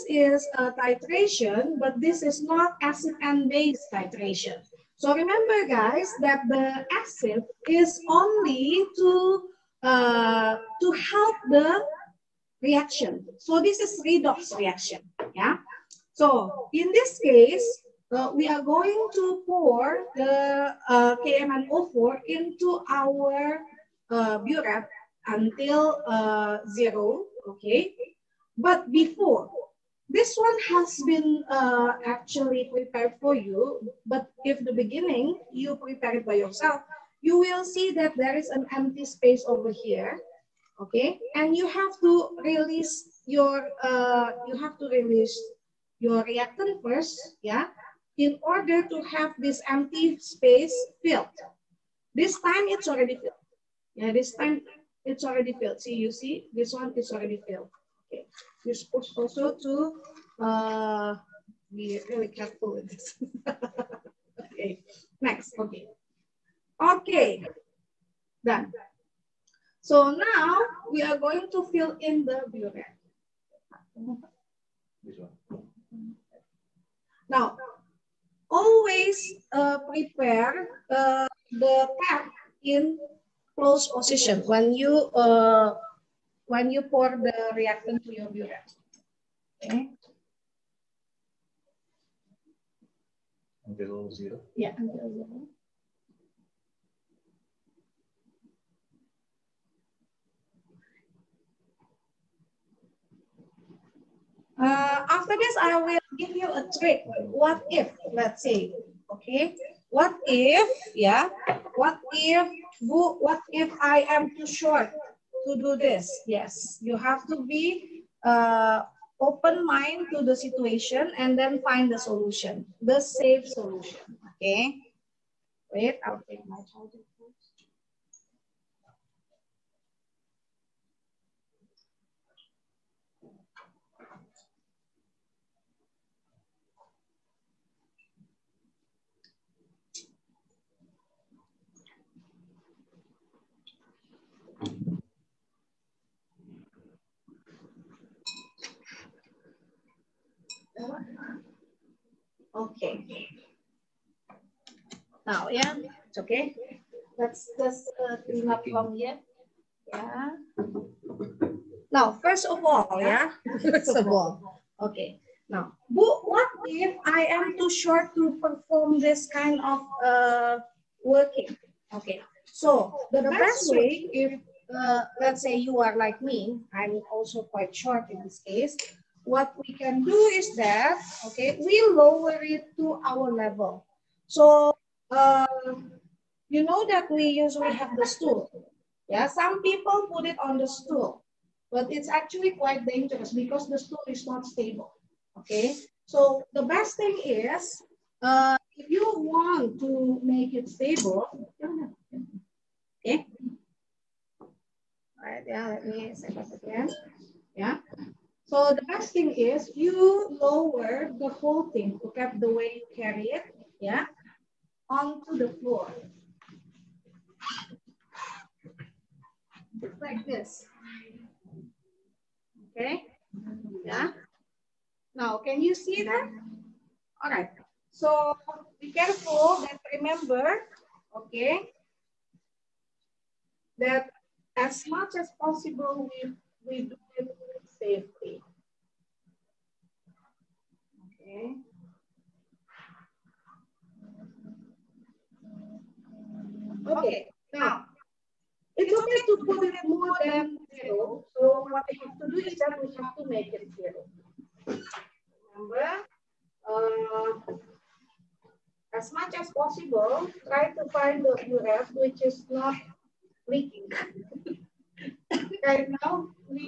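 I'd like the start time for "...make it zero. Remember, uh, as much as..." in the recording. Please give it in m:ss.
4:13.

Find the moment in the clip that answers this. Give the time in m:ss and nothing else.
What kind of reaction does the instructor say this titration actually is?
0:14.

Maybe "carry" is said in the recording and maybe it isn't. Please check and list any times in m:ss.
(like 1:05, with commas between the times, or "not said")
3:32.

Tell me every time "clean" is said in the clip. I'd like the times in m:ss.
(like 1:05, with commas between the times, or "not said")
2:38.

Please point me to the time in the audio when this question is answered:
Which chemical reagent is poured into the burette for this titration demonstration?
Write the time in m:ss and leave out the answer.
0:21.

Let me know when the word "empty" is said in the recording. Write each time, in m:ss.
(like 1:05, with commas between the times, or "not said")
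0:38, 0:49.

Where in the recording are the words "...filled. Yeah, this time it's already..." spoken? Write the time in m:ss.
0:53.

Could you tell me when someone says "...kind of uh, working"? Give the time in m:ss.
2:49.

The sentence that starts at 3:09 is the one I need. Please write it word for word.
Yeah, some people put it on the stool, but it's actually quite dangerous because the stool is not stable, okay?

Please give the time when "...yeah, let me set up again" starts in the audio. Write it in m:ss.
3:25.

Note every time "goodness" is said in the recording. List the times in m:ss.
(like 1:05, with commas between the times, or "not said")
not said.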